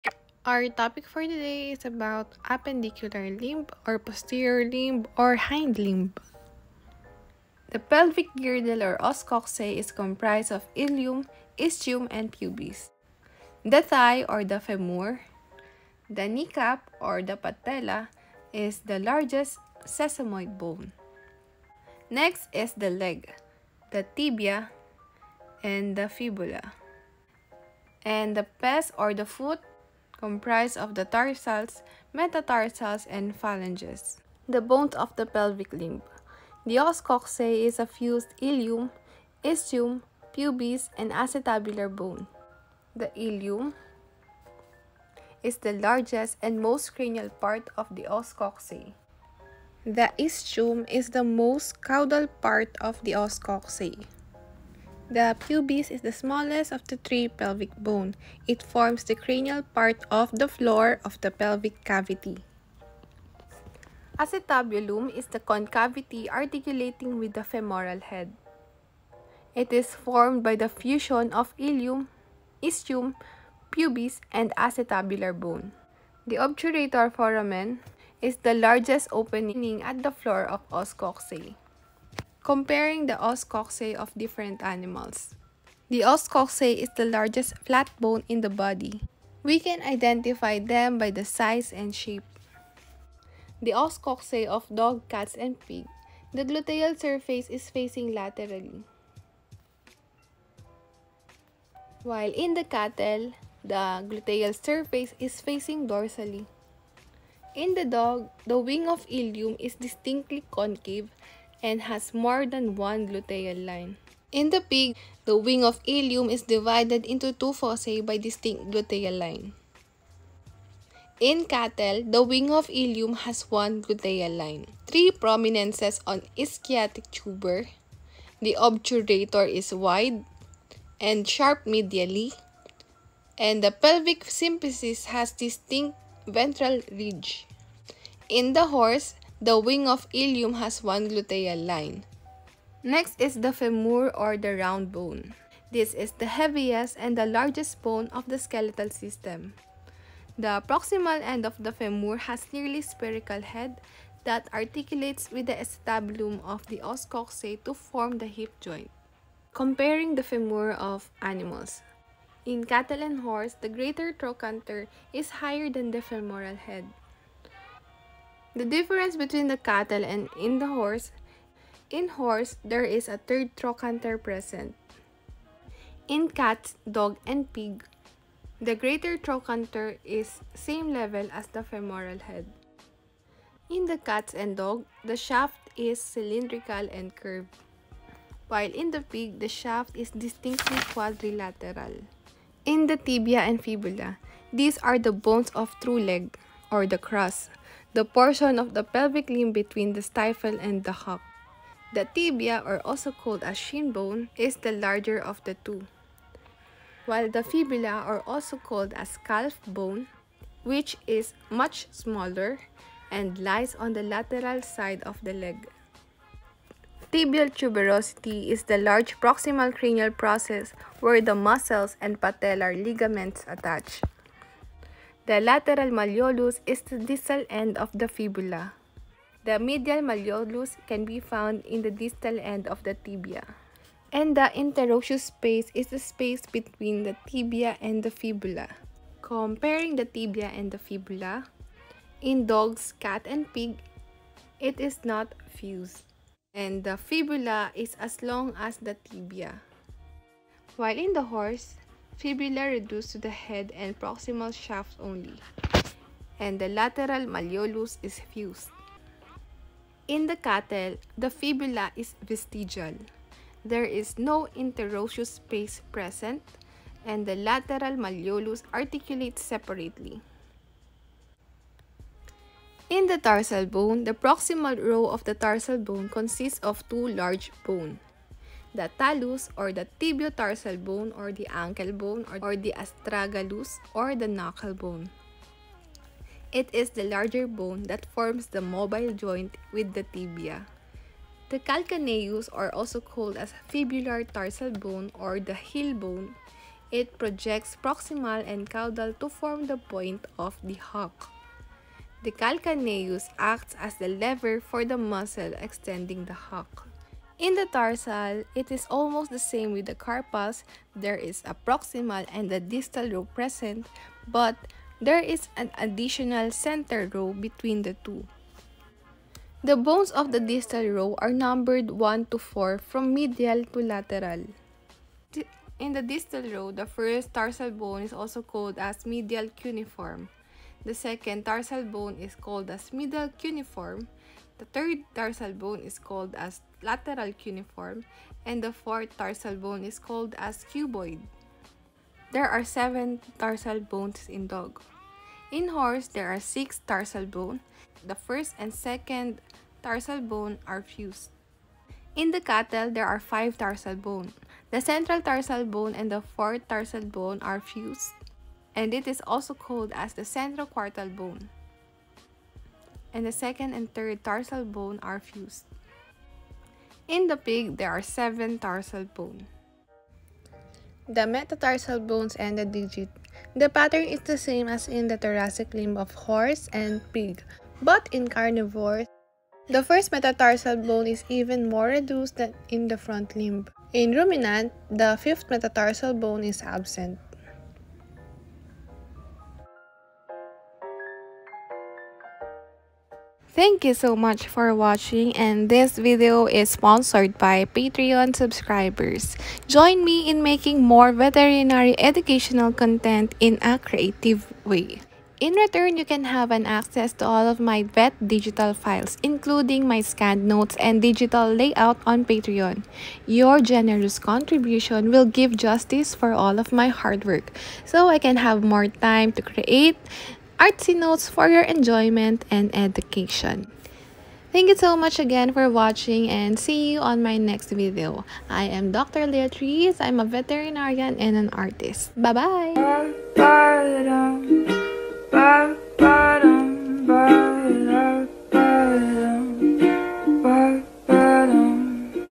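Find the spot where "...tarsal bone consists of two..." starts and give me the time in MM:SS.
04:35.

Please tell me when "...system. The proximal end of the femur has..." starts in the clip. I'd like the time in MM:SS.
02:28.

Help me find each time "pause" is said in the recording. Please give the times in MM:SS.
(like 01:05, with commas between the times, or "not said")
not said.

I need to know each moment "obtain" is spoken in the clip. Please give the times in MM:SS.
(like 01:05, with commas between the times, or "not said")
not said.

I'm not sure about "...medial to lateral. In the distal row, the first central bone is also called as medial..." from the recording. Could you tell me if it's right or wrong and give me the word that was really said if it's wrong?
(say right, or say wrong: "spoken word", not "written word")
wrong: "tarsal", not "central".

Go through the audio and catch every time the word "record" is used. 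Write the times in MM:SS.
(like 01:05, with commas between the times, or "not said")
not said.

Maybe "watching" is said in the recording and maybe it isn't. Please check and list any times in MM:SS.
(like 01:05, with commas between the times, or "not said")
06:34, 07:05.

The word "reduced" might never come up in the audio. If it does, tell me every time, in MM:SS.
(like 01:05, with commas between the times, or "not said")
04:12, 06:21.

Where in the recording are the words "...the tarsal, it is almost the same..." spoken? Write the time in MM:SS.
05:07.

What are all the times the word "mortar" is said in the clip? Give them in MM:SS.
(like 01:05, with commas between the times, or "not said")
not said.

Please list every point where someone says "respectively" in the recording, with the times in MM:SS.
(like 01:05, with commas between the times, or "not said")
not said.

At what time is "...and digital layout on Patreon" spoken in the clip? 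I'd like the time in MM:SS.
06:50.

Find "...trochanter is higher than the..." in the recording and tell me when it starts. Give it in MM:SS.
02:44.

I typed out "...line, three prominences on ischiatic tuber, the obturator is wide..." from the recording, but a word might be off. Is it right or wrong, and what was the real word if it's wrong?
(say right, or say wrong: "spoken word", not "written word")
right.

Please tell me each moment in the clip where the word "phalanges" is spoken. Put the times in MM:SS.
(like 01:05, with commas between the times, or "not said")
00:33.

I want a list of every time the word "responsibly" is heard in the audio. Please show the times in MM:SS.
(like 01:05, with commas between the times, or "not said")
not said.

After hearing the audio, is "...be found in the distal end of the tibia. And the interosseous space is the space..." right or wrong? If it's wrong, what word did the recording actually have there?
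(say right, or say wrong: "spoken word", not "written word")
right.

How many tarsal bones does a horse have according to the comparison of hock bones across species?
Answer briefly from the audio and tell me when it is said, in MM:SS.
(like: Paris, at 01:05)
6, at 05:46.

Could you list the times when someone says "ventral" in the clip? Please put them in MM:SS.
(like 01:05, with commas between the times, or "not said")
02:16.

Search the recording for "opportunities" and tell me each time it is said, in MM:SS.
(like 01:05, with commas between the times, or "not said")
not said.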